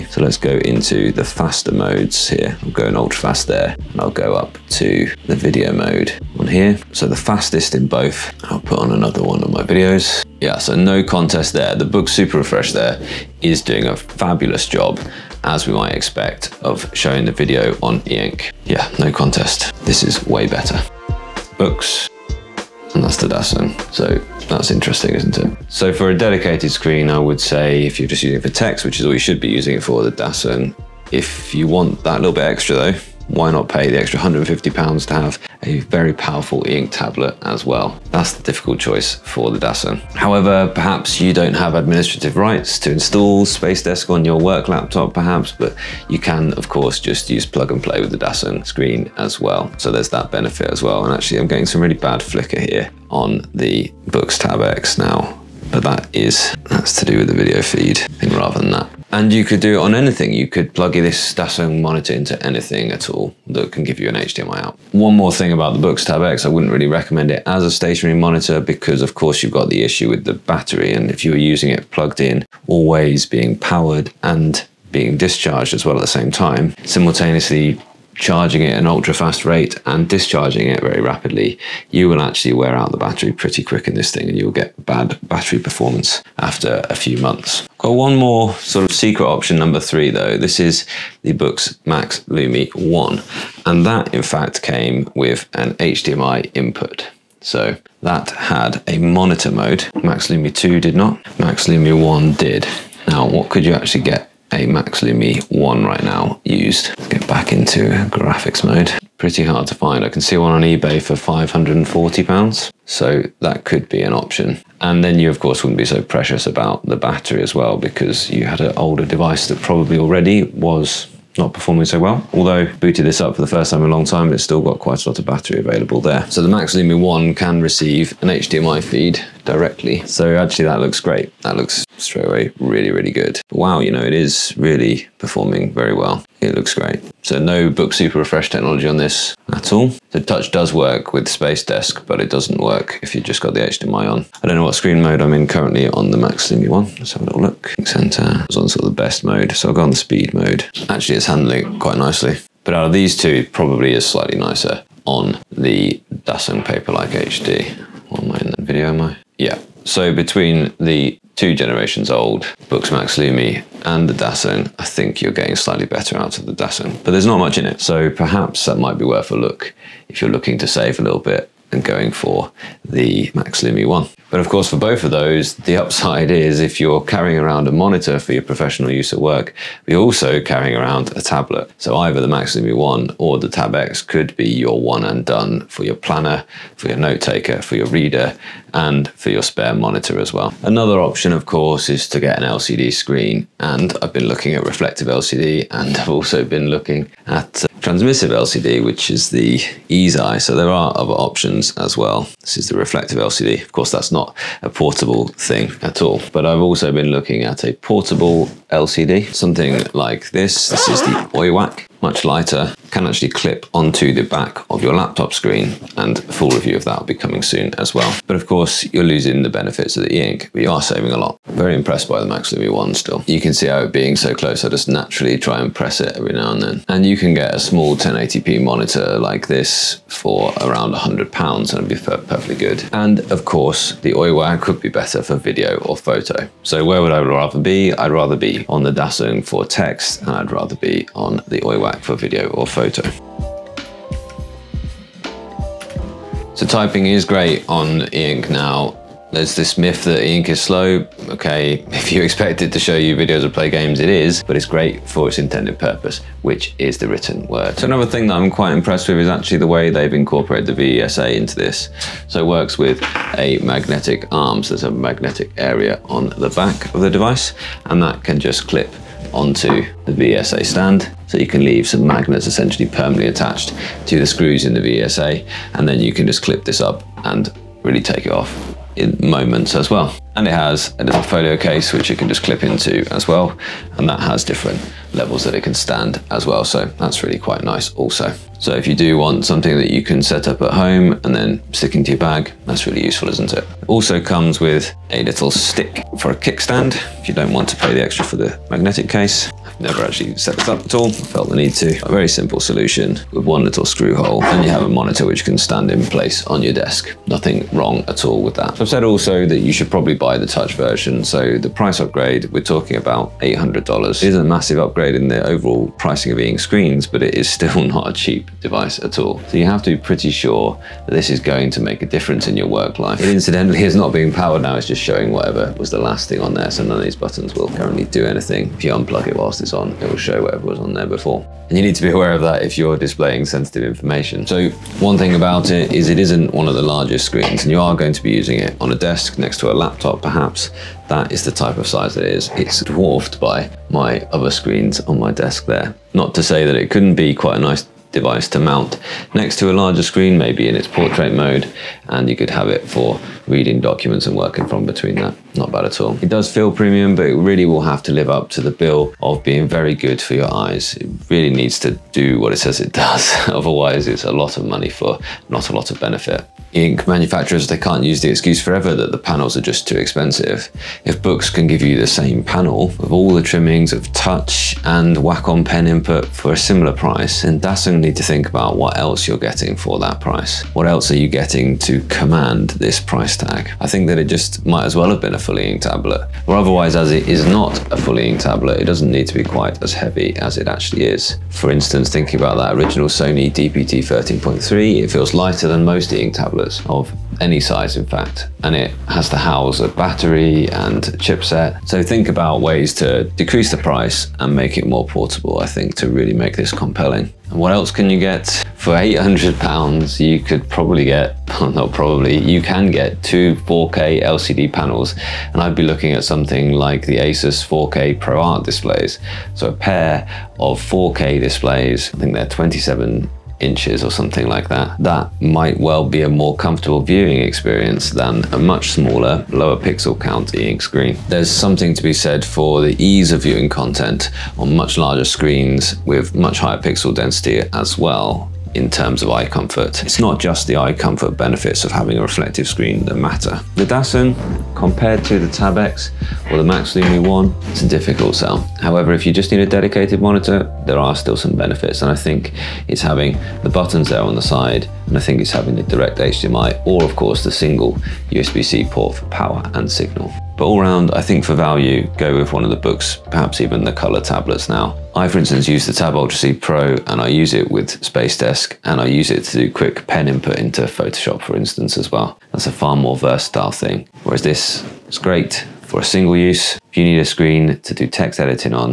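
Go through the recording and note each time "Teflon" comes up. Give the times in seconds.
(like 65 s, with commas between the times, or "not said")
not said.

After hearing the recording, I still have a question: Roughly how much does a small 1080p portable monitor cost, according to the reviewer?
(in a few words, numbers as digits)
100 pounds.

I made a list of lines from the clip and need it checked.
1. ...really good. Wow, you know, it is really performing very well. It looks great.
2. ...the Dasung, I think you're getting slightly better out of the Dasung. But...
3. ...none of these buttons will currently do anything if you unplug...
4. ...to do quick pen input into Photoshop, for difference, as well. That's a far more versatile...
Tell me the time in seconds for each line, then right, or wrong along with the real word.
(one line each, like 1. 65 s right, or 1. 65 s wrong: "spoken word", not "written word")
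1. 132 s right
2. 164 s right
3. 326 s right
4. 469 s wrong: "instance", not "difference".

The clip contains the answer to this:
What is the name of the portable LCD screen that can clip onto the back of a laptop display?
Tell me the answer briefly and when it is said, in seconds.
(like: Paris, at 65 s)
OIWAC, at 211 s.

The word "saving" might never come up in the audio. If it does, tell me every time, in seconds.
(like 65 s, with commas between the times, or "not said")
220 s.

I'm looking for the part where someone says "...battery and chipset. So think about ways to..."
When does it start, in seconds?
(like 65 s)
399 s.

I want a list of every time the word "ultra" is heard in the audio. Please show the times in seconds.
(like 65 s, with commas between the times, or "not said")
2 s, 78 s, 466 s.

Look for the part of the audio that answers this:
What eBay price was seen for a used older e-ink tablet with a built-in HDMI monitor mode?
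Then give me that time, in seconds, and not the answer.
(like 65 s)
111 s.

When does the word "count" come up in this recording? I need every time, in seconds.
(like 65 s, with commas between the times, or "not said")
430 s.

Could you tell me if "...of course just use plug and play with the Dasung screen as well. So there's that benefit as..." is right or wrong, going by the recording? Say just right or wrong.
right.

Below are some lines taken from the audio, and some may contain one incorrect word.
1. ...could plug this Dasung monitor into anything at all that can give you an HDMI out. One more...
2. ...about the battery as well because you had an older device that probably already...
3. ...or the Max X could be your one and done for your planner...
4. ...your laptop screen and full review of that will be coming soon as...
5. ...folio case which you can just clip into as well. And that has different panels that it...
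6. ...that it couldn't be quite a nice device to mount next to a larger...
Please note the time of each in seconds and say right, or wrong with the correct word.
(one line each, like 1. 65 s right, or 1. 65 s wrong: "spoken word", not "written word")
1. 60 s right
2. 116 s right
3. 183 s wrong: "Tab", not "Max"
4. 214 s right
5. 281 s wrong: "levels", not "panels"
6. 346 s right.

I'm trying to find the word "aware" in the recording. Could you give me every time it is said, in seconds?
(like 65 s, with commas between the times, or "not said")
332 s.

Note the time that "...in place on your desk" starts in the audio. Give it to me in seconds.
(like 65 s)
305 s.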